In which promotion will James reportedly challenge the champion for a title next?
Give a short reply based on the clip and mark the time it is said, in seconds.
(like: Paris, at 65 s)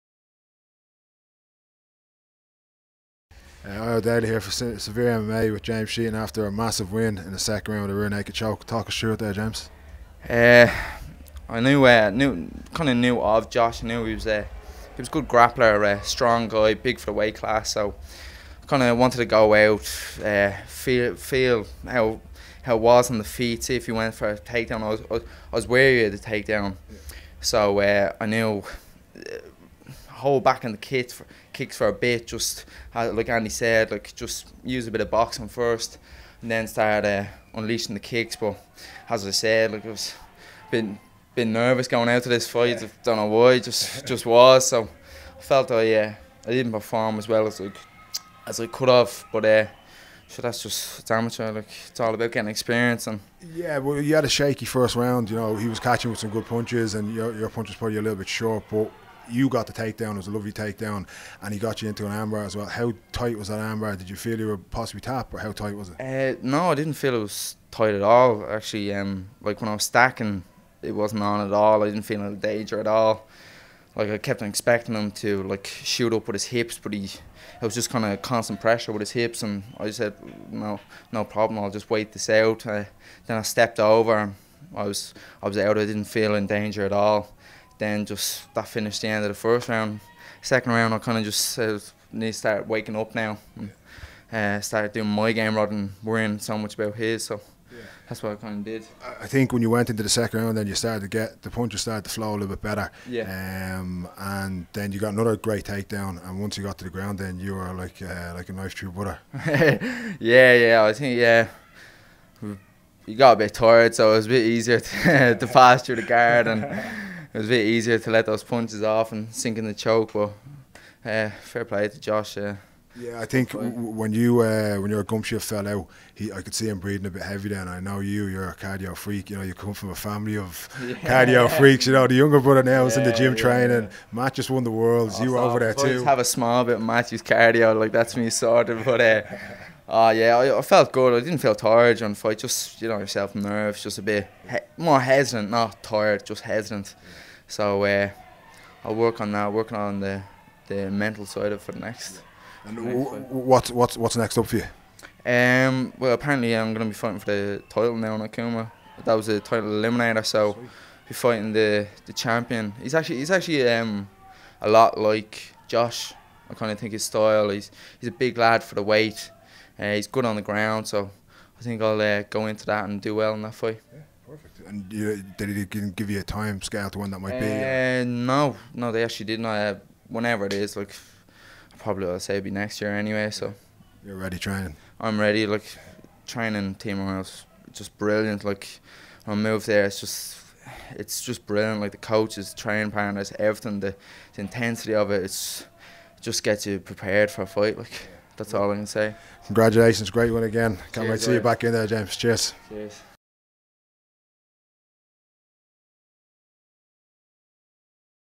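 Akuma, at 158 s.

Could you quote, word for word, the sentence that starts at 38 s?
But as I said, like I was been been nervous going out to this fight.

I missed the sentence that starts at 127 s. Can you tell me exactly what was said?
I know you, you're a cardio freak.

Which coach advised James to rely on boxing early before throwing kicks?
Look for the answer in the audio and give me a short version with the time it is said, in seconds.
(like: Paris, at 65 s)
Andy, at 33 s.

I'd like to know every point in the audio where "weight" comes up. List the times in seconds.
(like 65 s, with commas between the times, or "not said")
17 s, 168 s.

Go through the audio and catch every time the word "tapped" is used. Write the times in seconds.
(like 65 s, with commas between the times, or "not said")
65 s.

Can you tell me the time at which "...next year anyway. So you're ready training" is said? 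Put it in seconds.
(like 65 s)
182 s.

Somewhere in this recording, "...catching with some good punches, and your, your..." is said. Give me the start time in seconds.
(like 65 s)
55 s.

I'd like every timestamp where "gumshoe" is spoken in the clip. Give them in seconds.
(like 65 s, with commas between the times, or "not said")
125 s.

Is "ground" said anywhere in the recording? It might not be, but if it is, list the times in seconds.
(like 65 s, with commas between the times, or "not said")
106 s, 170 s.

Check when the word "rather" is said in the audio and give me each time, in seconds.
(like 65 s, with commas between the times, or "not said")
95 s.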